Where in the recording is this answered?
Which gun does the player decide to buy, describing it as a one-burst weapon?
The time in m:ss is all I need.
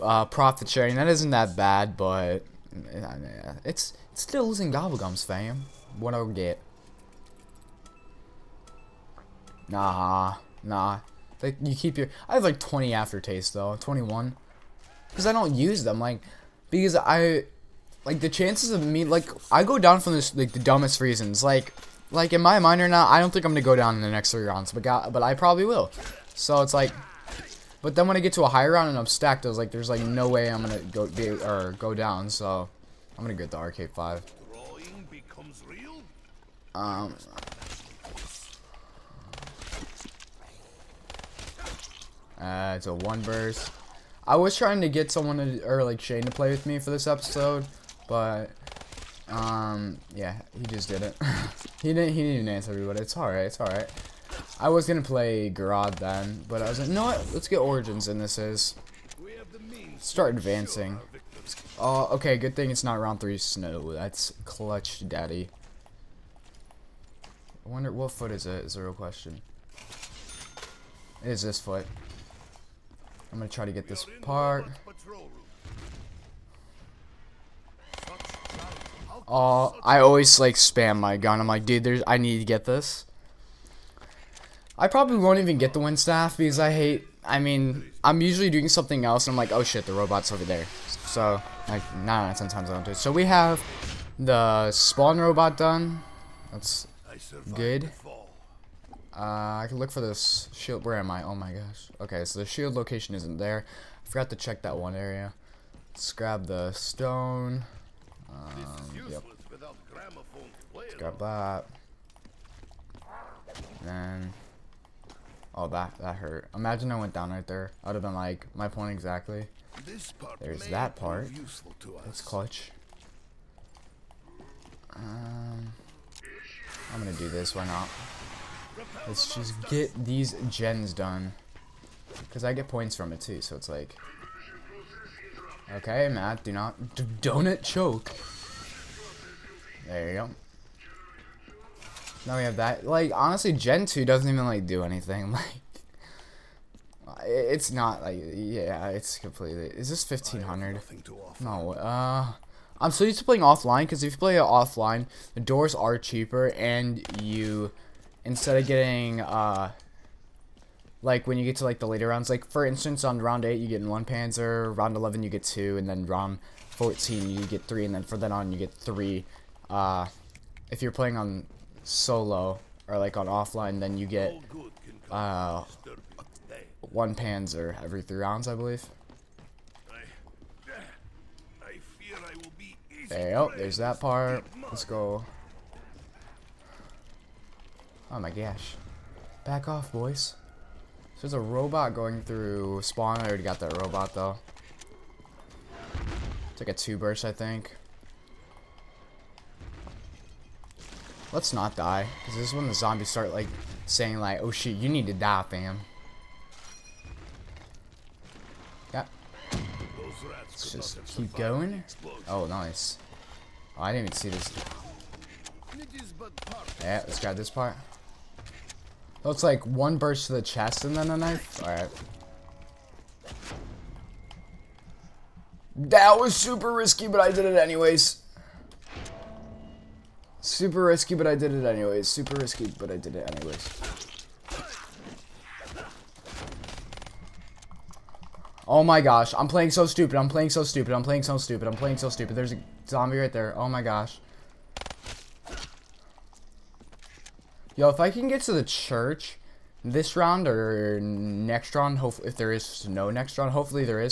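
0:33.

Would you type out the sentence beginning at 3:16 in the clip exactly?
It's like a two burst, I think.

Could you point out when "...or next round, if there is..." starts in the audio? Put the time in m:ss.
4:10.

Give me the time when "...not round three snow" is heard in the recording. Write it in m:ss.
1:02.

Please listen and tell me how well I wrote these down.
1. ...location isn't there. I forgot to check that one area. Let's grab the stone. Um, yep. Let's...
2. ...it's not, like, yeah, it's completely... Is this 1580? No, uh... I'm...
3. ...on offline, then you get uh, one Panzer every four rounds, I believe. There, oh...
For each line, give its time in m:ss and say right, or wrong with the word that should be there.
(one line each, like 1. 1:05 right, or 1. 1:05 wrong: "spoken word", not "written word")
1. 1:42 right
2. 2:27 wrong: "1500", not "1580"
3. 2:53 wrong: "three", not "four".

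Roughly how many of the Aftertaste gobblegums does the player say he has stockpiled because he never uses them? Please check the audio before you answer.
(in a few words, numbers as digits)
21.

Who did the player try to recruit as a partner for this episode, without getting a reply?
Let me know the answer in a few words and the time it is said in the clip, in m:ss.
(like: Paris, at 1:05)
Shane, at 0:45.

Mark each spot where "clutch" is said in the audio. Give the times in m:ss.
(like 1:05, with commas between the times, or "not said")
1:04, 2:02.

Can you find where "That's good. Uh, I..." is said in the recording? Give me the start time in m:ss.
1:36.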